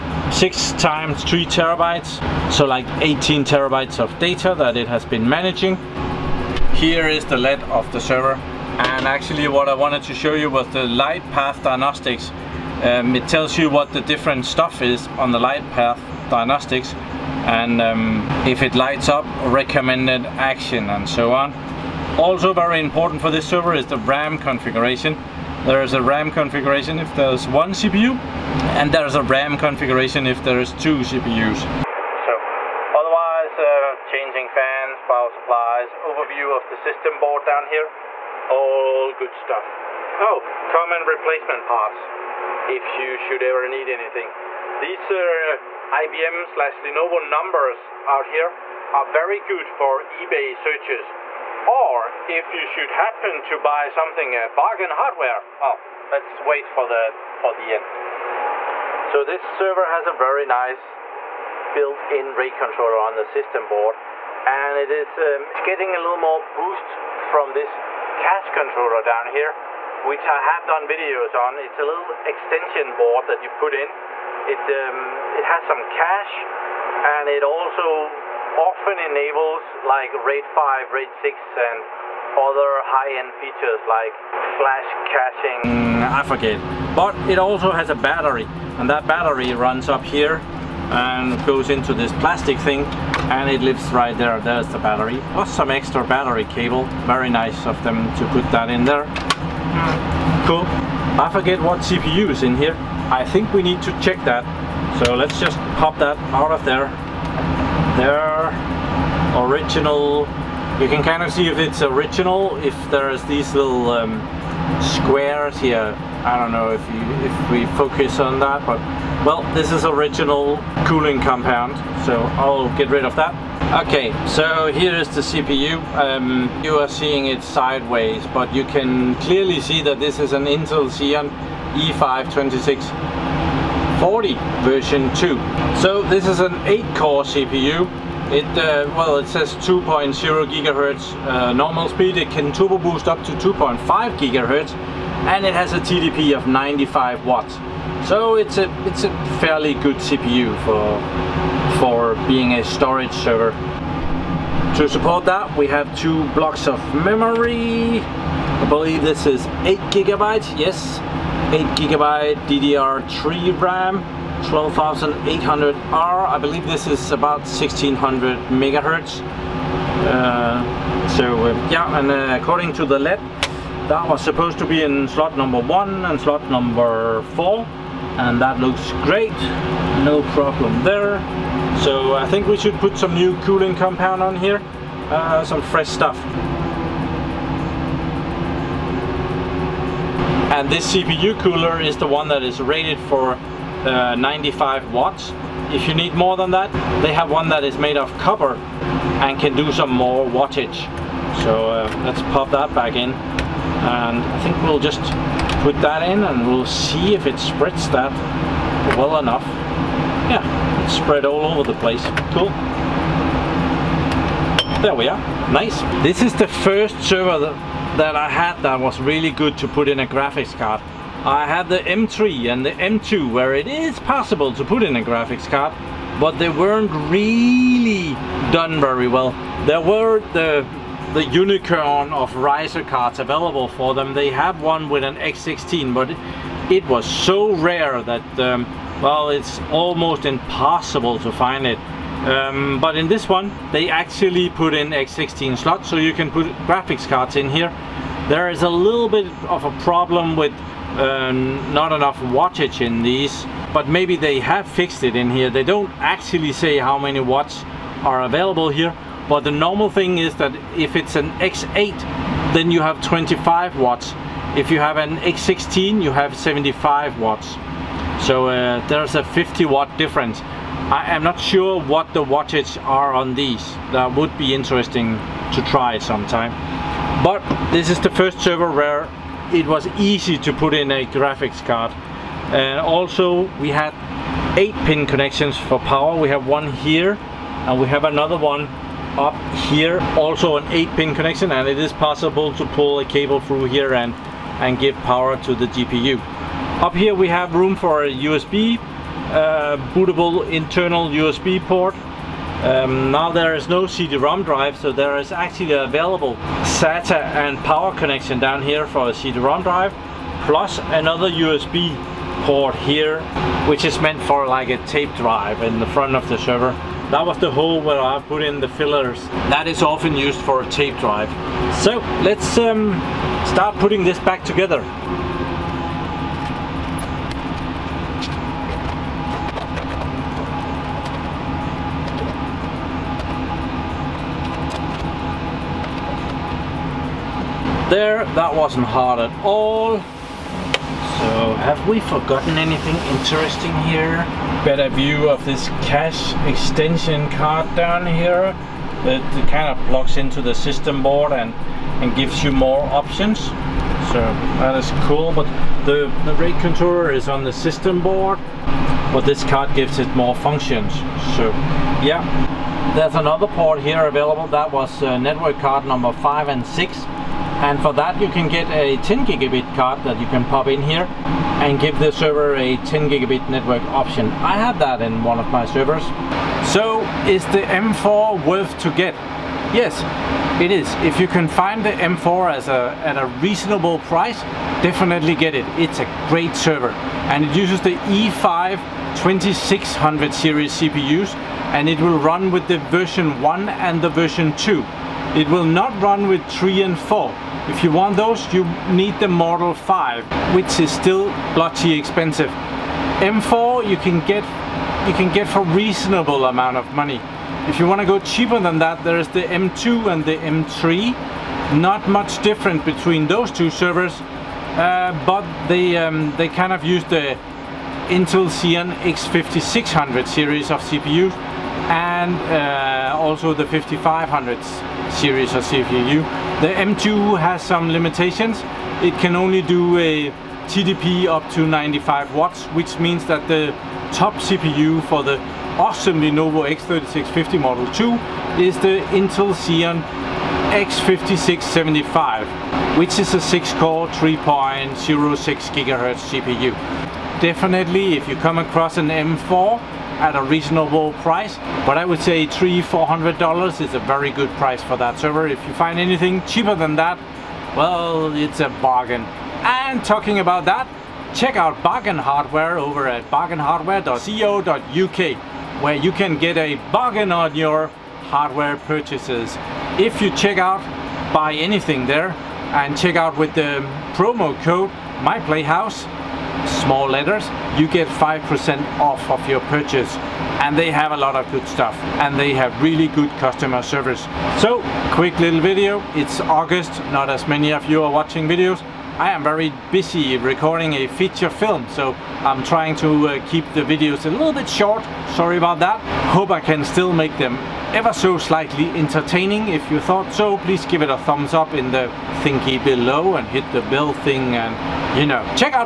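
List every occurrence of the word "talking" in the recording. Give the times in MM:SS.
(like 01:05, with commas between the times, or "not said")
07:40.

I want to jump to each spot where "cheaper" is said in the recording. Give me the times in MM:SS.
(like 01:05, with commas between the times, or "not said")
06:48, 07:36.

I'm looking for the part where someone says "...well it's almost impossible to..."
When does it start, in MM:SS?
03:59.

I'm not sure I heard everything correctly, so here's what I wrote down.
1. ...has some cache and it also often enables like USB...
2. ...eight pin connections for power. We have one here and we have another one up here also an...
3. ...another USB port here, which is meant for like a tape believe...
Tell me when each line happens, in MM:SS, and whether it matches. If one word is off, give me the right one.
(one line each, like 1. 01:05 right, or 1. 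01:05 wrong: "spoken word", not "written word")
1. 01:15 wrong: "RAID", not "USB"
2. 04:44 right
3. 05:10 wrong: "drive", not "believe".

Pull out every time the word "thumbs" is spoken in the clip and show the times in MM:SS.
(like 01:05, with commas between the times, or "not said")
08:21.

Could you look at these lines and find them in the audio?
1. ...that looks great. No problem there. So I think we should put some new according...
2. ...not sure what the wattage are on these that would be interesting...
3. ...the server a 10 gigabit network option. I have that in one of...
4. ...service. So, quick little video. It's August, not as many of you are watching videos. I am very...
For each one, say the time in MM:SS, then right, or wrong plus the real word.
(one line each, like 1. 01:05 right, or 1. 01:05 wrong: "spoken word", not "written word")
1. 02:58 wrong: "cooling", not "according"
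2. 04:31 right
3. 06:11 right
4. 08:03 right.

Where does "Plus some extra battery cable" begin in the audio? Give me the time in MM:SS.
01:35.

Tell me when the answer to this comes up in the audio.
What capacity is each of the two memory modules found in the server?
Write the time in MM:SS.
02:39.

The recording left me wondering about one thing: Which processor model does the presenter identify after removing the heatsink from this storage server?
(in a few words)
Intel Xeon E5 2640 version 2.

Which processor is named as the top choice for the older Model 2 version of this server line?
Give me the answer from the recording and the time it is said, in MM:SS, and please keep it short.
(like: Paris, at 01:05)
Intel Xeon X5675, at 07:19.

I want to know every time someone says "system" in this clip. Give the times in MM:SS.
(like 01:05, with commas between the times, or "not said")
00:36, 01:03, 05:50, 05:57.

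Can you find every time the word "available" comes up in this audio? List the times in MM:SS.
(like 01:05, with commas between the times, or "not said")
03:53, 04:18, 05:05, 06:04.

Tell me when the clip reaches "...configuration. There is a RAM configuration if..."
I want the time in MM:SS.
00:24.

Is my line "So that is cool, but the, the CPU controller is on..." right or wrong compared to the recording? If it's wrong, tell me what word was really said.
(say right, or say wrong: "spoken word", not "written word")
wrong: "RAID", not "CPU".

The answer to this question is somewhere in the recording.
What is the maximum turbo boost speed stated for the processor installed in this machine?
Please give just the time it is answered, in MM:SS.
02:23.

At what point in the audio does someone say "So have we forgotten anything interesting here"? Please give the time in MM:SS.
05:39.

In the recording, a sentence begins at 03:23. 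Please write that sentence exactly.
And I think we'll just put that in and we'll see if it spreads that well enough.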